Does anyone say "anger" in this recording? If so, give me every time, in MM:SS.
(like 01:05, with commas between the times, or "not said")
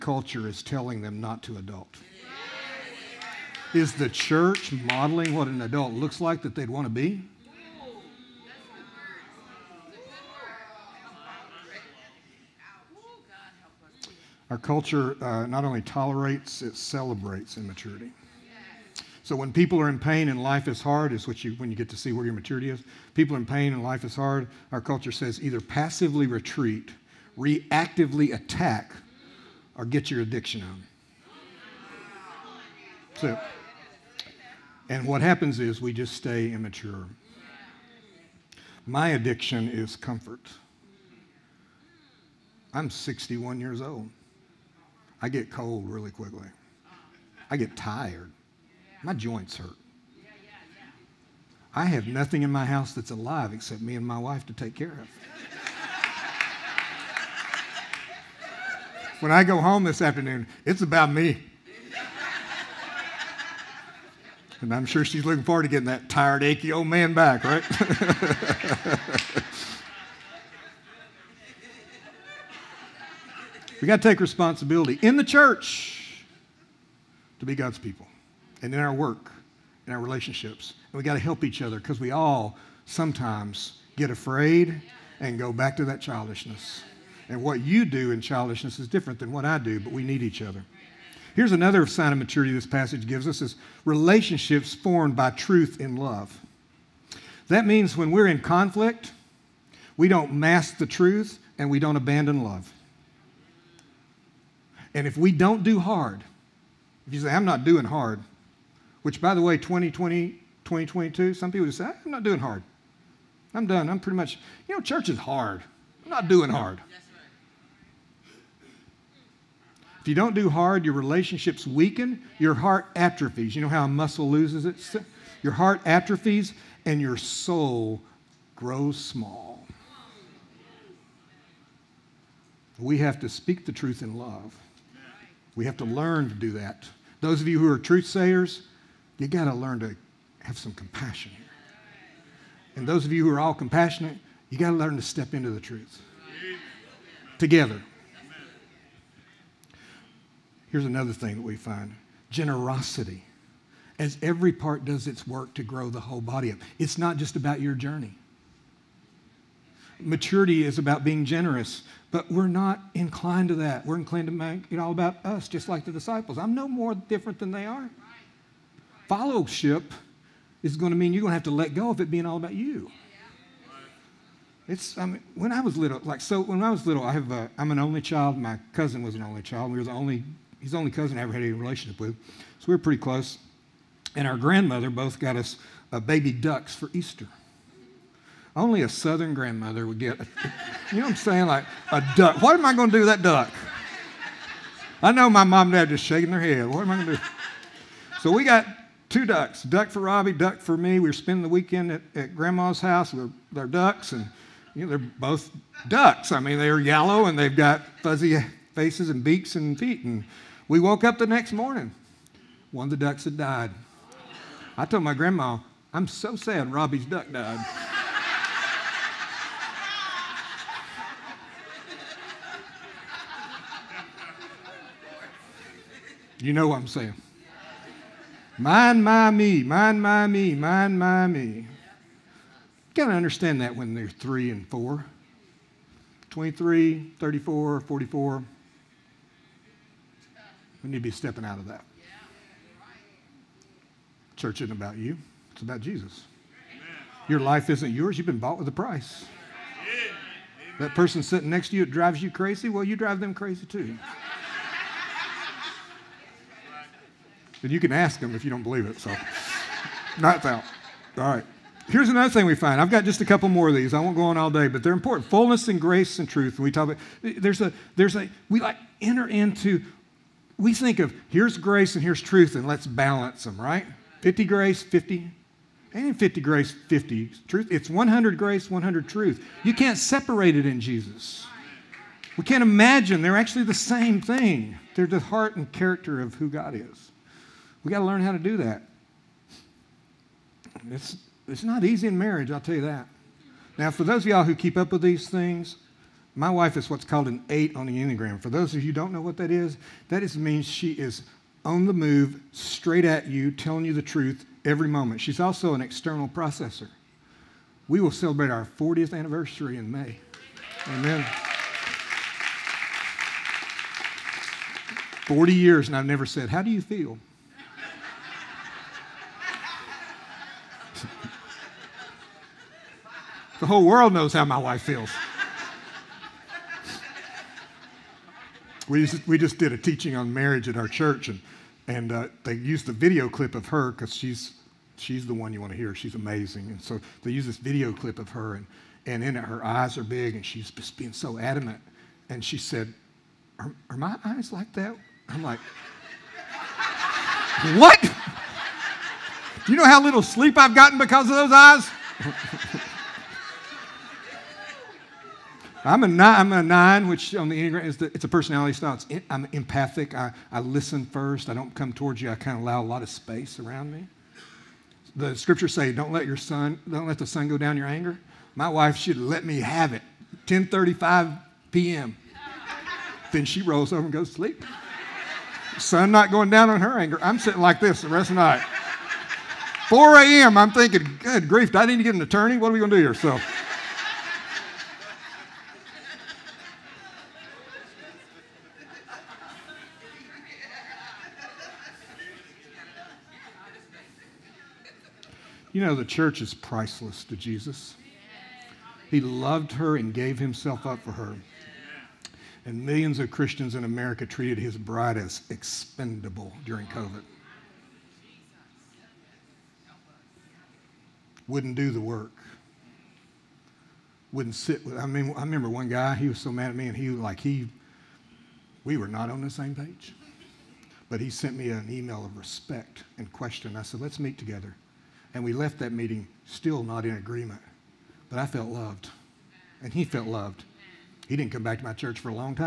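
06:07, 06:16.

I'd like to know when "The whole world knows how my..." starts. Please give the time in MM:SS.
05:23.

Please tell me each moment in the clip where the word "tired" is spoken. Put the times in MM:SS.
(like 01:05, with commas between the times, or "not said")
00:47, 01:06.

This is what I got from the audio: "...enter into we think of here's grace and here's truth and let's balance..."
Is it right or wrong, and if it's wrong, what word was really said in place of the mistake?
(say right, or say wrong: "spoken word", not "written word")
right.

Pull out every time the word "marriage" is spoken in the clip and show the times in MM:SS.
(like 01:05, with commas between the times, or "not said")
04:52, 05:30.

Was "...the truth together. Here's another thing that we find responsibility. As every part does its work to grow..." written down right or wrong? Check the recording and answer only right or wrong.
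wrong.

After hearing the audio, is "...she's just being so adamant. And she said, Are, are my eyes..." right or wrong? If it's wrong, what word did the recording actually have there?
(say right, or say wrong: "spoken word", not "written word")
right.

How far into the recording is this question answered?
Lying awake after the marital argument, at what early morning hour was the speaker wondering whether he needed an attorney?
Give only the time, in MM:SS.
06:19.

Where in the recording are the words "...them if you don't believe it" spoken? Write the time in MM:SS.
04:18.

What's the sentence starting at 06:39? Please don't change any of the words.
He loved her and gave himself up for her.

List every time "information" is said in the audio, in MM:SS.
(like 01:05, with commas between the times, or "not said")
not said.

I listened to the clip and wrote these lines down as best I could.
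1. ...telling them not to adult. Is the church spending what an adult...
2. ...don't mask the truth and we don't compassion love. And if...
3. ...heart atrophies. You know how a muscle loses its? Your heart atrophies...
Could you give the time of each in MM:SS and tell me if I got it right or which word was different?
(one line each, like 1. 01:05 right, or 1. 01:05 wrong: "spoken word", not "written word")
1. 00:00 wrong: "modeling", not "spending"
2. 01:40 wrong: "abandon", not "compassion"
3. 02:02 right.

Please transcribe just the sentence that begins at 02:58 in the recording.
My cousin was an only child.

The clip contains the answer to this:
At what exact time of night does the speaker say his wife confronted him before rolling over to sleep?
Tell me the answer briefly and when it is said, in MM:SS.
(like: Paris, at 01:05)
10:35 p.m., at 06:10.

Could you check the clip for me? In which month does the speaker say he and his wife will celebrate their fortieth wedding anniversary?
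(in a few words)
May.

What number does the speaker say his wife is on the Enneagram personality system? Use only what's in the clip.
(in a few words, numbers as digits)
8.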